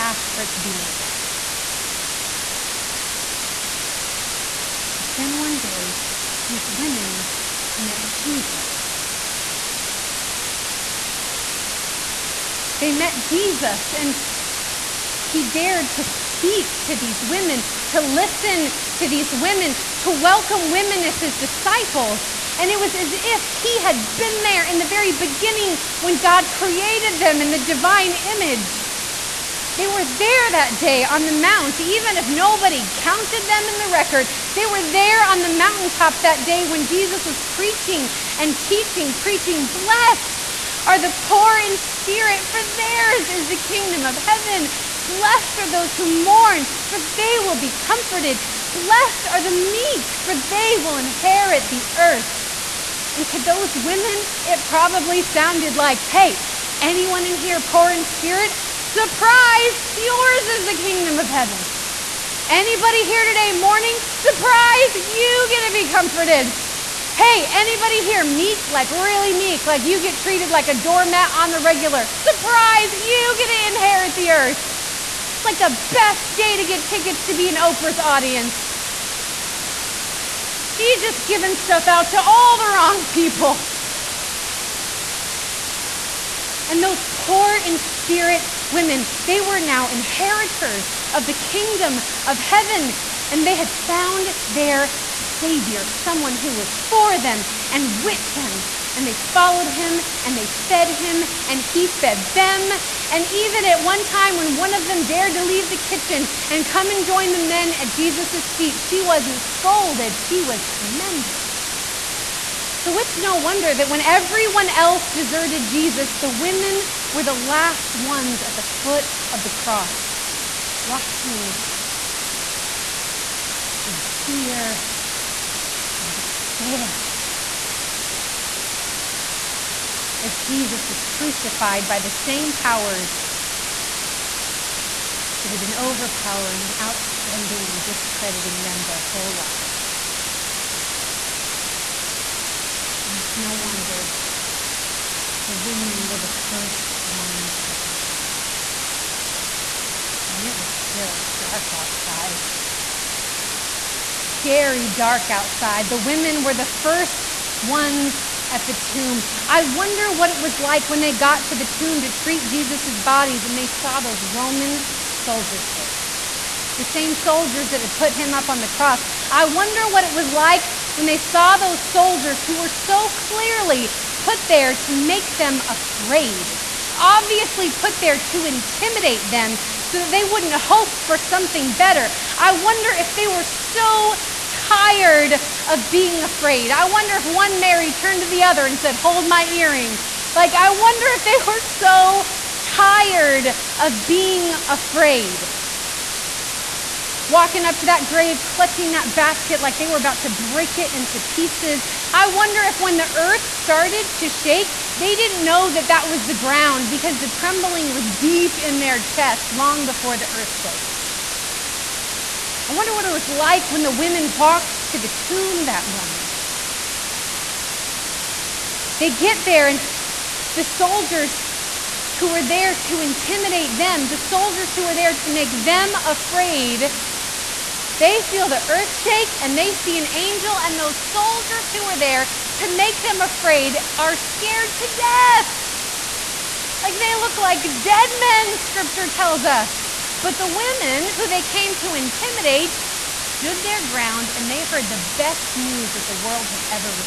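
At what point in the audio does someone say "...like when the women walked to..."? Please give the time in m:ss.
3:33.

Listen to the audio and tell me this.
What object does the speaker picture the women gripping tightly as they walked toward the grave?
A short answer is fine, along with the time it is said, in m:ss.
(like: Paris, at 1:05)
Basket, at 3:19.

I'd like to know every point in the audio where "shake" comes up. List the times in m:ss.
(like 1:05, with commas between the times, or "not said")
3:24, 3:48.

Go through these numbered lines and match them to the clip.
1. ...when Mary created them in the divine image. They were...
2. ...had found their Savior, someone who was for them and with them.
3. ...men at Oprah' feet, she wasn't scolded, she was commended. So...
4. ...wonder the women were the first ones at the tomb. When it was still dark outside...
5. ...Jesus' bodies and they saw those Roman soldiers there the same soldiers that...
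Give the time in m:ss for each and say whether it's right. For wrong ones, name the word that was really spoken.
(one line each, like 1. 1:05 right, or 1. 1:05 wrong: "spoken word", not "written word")
1. 0:25 wrong: "God", not "Mary"
2. 1:33 right
3. 1:47 wrong: "Jesus", not "Oprah"
4. 2:23 right
5. 2:42 right.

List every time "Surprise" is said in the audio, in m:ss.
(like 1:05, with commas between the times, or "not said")
0:58, 1:04, 1:12.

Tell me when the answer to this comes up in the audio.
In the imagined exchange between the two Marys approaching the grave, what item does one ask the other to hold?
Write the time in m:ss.
3:09.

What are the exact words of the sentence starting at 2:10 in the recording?
As Jesus was crucified by the same powers that had been overpowering, outspending, and discrediting them their whole lives.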